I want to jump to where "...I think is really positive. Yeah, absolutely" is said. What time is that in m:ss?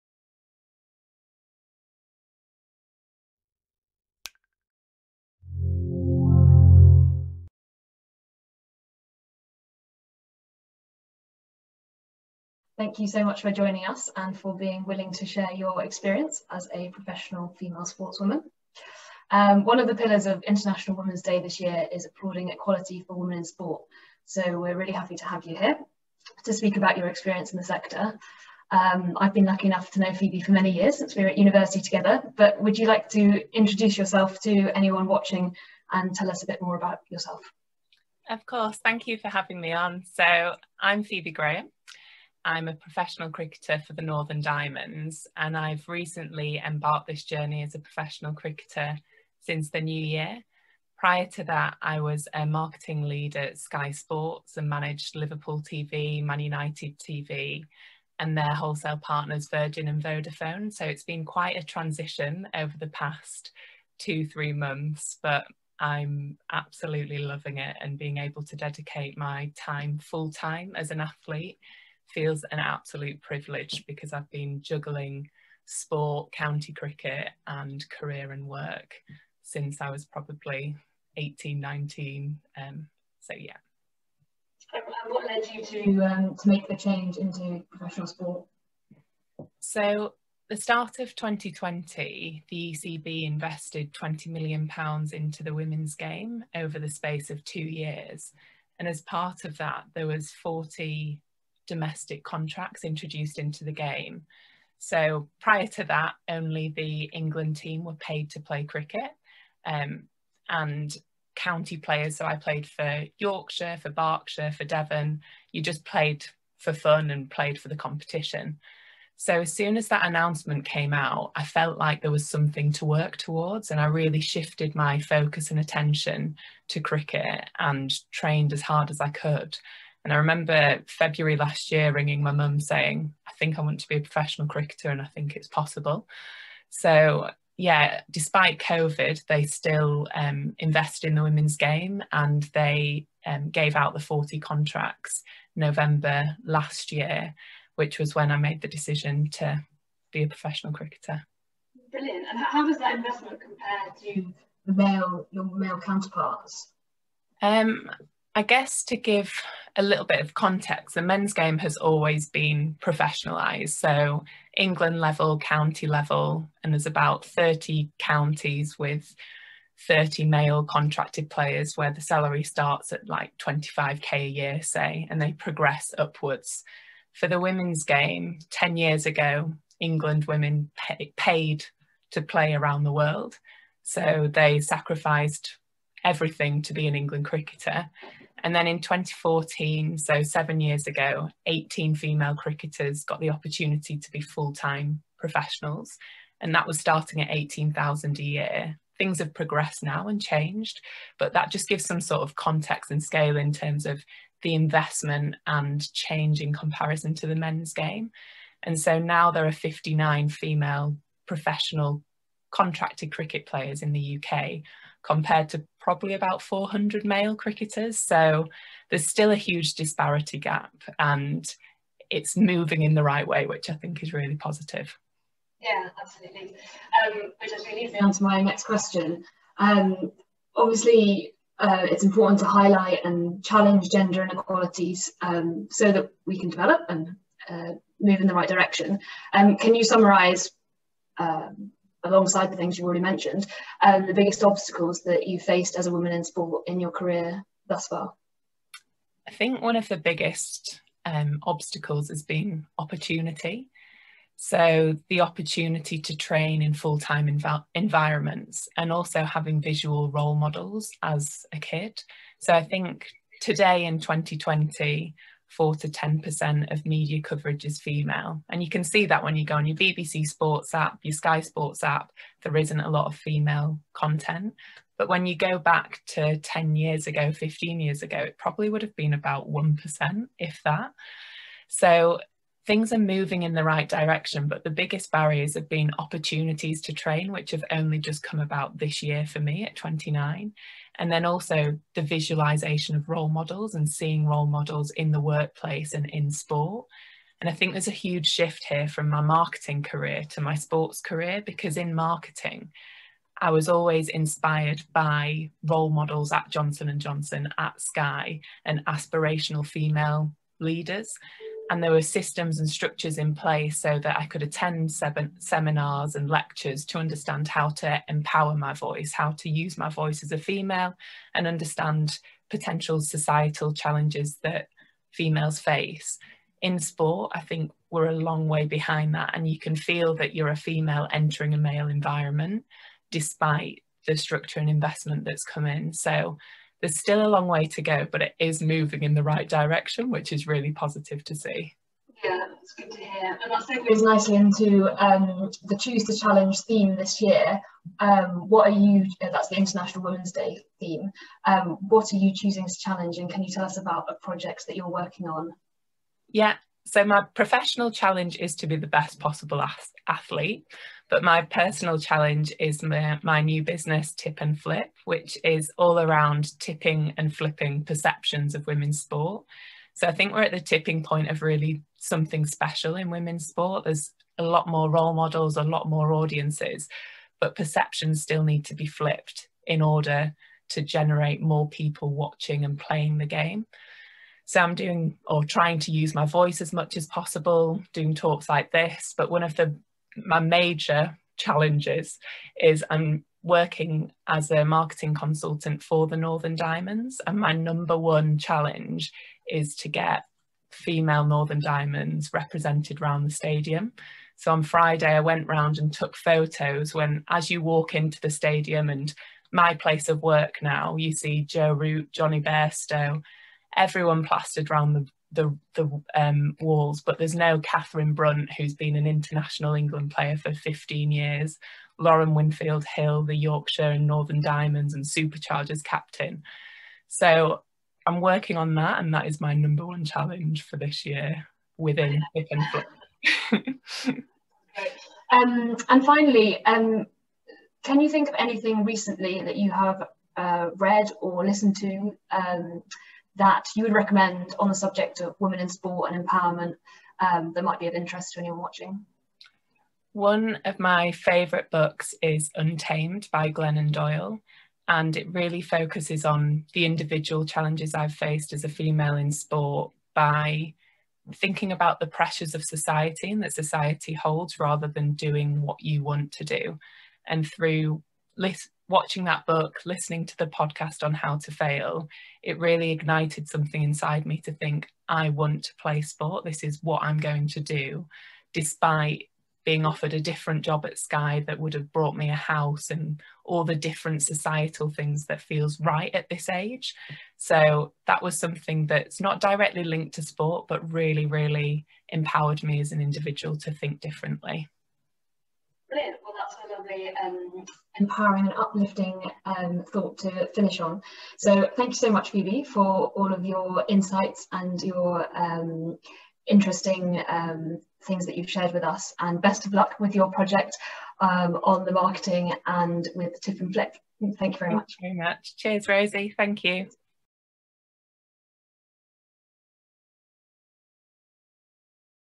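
3:43.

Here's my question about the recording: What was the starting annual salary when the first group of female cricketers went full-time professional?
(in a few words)
18,000.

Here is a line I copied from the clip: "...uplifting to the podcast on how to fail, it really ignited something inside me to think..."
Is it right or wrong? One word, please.
wrong.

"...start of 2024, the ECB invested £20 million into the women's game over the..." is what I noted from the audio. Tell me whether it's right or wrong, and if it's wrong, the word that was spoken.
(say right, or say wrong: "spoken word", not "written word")
wrong: "2020", not "2024".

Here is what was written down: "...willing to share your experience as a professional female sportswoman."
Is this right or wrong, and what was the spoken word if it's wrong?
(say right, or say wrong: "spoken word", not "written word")
right.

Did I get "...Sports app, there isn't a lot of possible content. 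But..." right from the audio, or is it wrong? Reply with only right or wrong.
wrong.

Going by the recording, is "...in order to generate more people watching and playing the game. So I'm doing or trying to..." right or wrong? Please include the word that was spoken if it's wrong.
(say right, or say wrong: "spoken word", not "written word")
right.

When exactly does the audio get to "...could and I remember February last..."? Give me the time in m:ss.
2:09.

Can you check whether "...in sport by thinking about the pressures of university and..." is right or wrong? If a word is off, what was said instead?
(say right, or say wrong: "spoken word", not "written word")
wrong: "society", not "university".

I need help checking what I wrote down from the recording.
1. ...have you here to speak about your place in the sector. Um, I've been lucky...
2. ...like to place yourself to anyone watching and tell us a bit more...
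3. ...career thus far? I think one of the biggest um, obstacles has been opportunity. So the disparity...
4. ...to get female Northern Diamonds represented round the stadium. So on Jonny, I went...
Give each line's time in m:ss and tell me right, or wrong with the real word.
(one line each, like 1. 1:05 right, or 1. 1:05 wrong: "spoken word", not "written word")
1. 0:25 wrong: "experience", not "place"
2. 0:32 wrong: "introduce", not "place"
3. 4:06 wrong: "opportunity", not "disparity"
4. 6:39 wrong: "Friday", not "Jonny".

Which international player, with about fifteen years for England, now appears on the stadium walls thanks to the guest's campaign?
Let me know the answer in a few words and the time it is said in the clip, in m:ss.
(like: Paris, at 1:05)
Katherine Brunt, at 6:57.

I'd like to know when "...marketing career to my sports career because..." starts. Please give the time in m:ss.
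4:59.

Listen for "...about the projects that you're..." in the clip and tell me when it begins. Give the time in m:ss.
5:53.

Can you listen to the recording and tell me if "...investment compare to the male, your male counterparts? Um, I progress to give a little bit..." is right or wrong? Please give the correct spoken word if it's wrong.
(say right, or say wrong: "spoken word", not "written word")
wrong: "guess", not "progress".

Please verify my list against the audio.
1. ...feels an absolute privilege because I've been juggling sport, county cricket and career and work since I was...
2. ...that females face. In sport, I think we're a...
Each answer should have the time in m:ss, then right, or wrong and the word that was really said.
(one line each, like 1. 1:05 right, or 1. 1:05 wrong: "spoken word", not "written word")
1. 1:12 right
2. 5:24 right.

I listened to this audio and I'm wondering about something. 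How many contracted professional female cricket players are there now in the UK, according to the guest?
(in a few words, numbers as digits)
59.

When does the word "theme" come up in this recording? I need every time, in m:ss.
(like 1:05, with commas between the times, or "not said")
5:46, 5:50.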